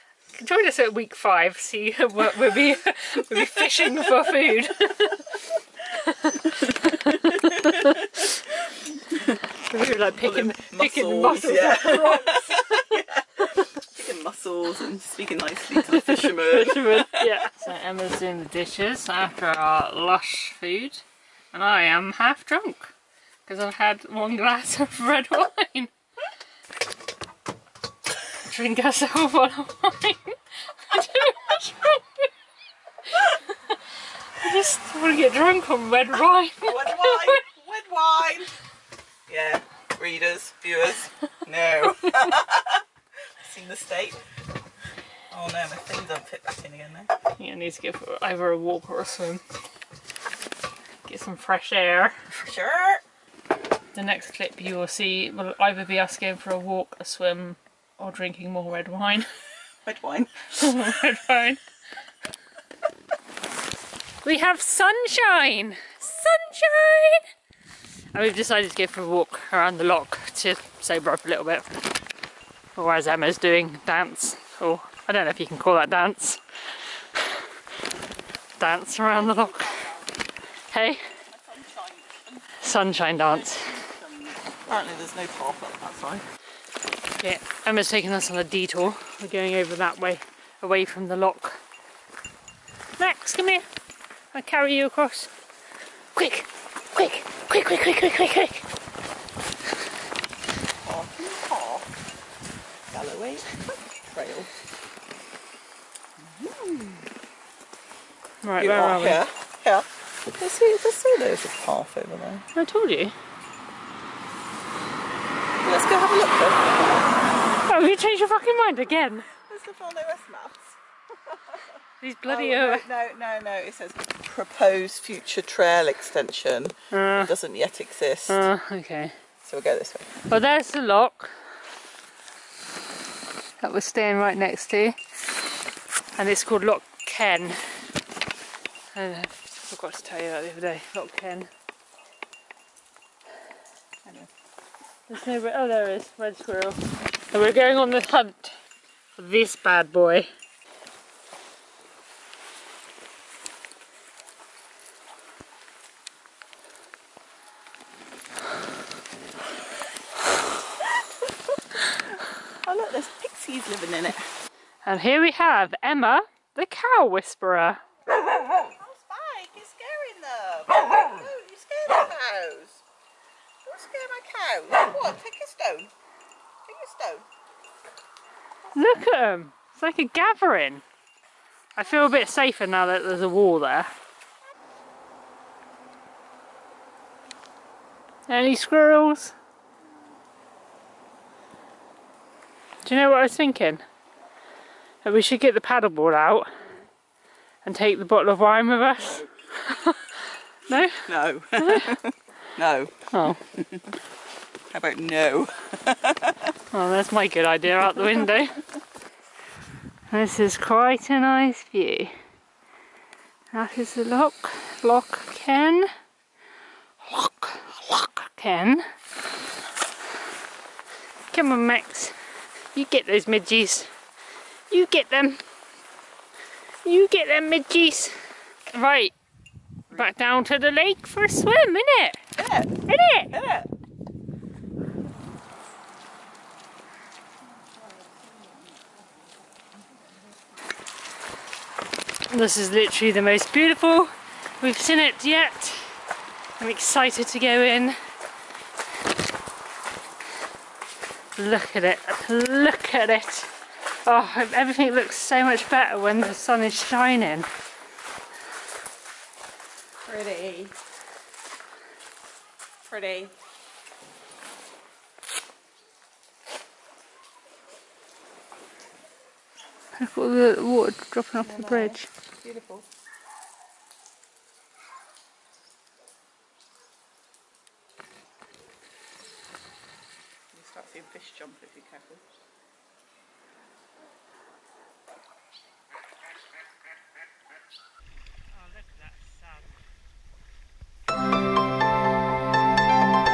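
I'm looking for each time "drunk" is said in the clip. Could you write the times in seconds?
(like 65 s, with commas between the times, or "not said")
22 s, 35 s.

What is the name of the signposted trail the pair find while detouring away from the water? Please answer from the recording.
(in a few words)
Galloway Trail.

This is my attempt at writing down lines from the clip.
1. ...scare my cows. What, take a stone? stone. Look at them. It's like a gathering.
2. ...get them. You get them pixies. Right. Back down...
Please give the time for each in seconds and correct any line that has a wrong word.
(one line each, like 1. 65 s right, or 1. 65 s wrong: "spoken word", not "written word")
1. 173 s right
2. 224 s wrong: "midges", not "pixies".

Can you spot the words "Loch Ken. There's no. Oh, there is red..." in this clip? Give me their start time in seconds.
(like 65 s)
140 s.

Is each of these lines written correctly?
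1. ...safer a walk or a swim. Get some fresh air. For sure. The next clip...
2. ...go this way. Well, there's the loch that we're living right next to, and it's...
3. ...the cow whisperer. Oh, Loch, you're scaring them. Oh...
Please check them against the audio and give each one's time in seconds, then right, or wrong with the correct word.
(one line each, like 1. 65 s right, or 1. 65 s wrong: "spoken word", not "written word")
1. 48 s wrong: "either", not "safer"
2. 129 s wrong: "staying", not "living"
3. 166 s wrong: "Spike", not "Loch".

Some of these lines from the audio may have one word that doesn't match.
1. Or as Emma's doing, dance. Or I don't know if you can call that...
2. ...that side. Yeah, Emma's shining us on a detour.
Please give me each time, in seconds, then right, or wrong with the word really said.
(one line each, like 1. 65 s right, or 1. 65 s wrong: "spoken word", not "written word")
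1. 72 s right
2. 85 s wrong: "taking", not "shining".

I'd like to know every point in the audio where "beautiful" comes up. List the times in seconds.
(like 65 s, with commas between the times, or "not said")
243 s, 272 s.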